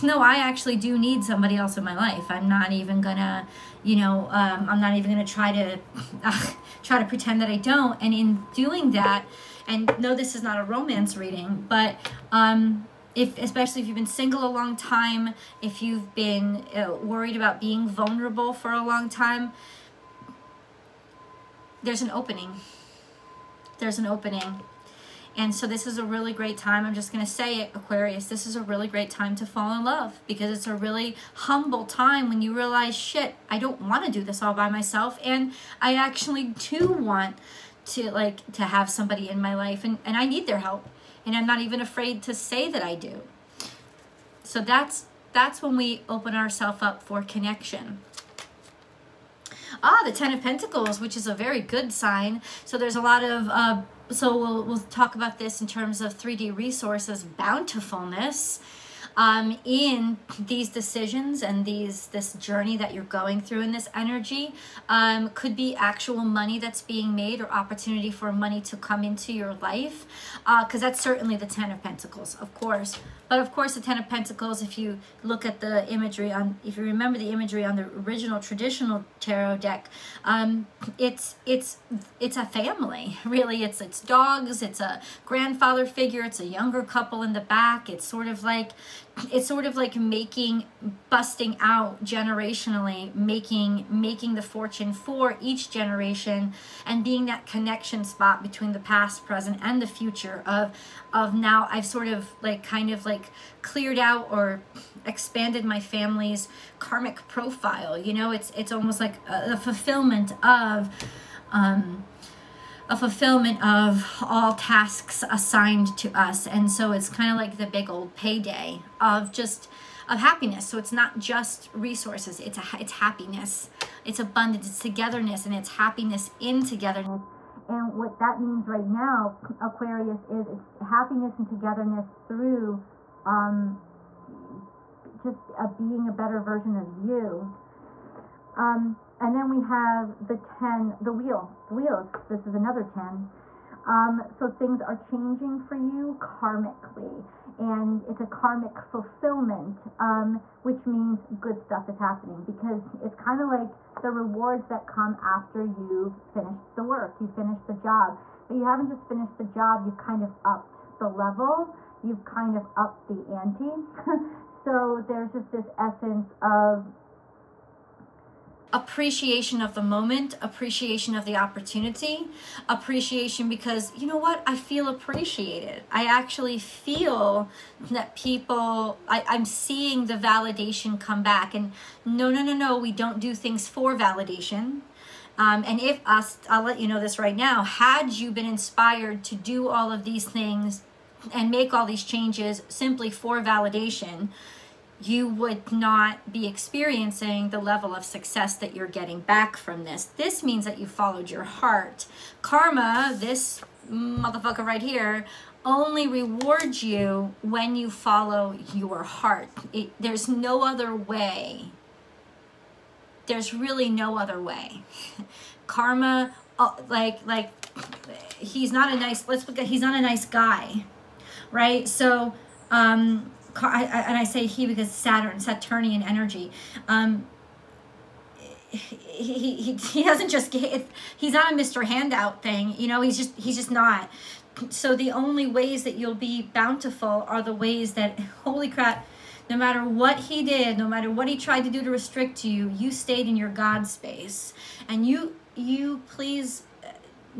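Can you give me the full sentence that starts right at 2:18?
Um, and then we have the 10, the wheel, the wheels.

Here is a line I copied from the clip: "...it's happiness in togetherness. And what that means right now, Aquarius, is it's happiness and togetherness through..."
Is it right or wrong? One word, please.
right.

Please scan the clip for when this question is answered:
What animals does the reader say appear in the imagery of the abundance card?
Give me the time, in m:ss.
1:24.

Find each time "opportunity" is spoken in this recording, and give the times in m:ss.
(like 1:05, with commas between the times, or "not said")
1:07, 2:51.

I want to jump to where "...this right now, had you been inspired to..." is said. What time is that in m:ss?
3:07.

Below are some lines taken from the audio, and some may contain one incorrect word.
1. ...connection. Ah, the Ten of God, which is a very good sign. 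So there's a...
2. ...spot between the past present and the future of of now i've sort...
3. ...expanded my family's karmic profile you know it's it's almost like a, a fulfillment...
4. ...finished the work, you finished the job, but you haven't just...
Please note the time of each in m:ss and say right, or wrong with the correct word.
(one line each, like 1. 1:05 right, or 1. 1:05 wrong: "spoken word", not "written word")
1. 0:47 wrong: "Pentacles", not "God"
2. 1:38 right
3. 1:45 right
4. 2:36 right.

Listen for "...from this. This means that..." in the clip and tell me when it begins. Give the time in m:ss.
3:19.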